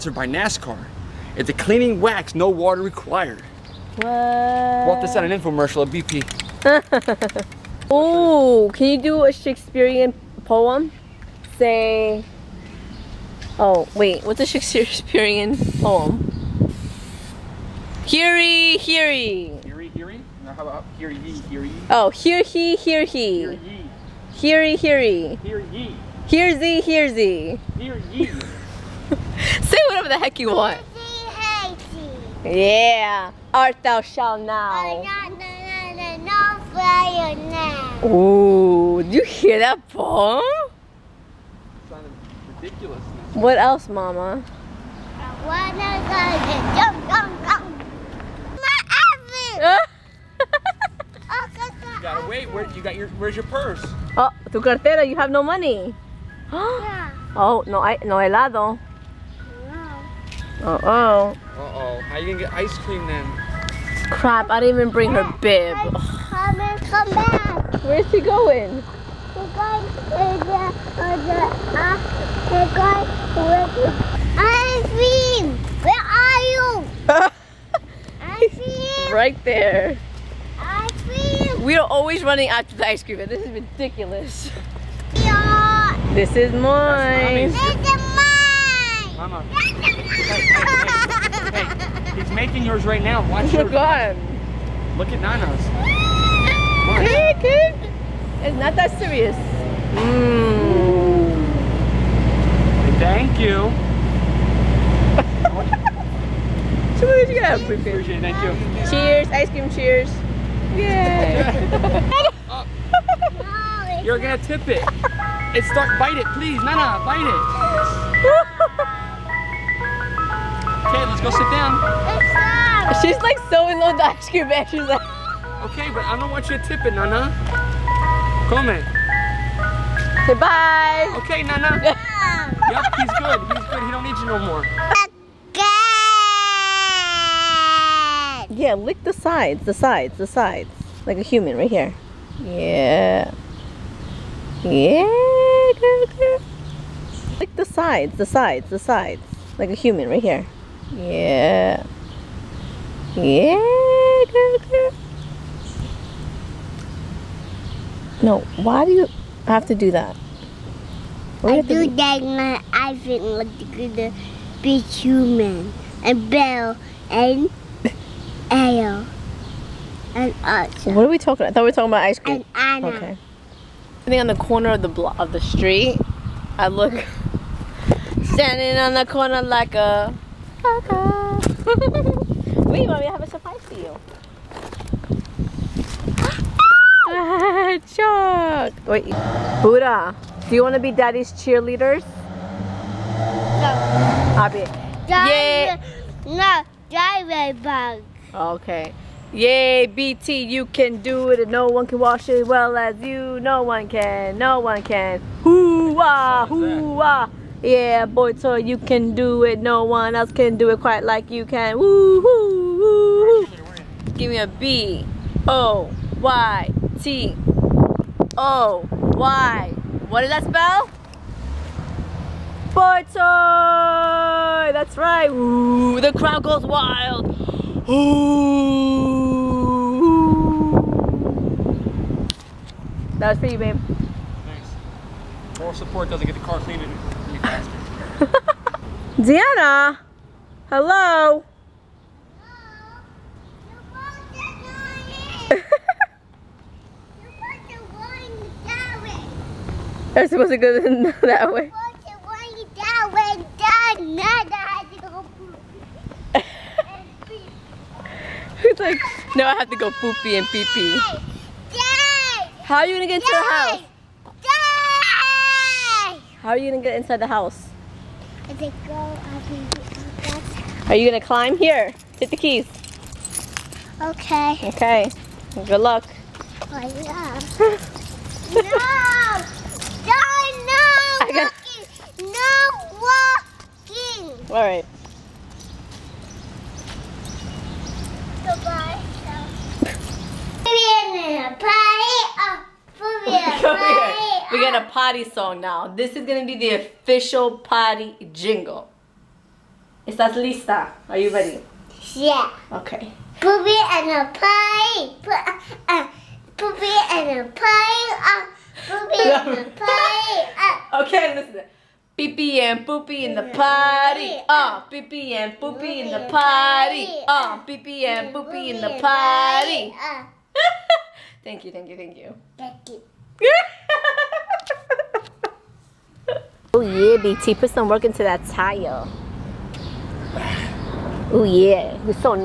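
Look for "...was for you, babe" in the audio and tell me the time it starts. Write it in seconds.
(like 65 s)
233 s.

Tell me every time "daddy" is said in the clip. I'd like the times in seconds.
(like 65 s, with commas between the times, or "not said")
190 s, 196 s.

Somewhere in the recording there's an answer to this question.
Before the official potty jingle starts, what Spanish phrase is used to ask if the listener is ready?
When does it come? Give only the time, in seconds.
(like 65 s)
300 s.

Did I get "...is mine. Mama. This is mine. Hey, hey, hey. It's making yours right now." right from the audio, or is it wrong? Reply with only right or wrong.
right.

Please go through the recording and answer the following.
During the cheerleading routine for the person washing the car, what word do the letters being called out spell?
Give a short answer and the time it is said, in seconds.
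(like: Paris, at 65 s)
Boytoy, at 222 s.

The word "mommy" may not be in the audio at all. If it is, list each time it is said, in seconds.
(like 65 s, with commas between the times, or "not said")
182 s.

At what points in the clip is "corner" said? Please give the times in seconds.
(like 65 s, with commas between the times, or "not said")
174 s, 179 s.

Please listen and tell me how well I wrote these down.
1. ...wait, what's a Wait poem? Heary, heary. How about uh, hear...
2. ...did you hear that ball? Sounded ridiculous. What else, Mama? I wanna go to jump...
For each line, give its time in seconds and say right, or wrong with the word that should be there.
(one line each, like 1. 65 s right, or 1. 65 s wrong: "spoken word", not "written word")
1. 13 s wrong: "Shakespearean", not "Wait"
2. 39 s right.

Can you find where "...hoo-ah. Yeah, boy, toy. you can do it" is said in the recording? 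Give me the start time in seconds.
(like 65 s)
206 s.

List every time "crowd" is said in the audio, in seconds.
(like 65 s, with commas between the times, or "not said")
226 s.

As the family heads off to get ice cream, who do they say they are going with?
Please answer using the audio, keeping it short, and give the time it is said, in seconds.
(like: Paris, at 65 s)
Irene, at 74 s.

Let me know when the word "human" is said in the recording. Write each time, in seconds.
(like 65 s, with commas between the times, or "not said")
141 s, 149 s, 164 s.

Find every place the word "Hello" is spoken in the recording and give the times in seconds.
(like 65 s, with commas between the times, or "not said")
240 s, 245 s.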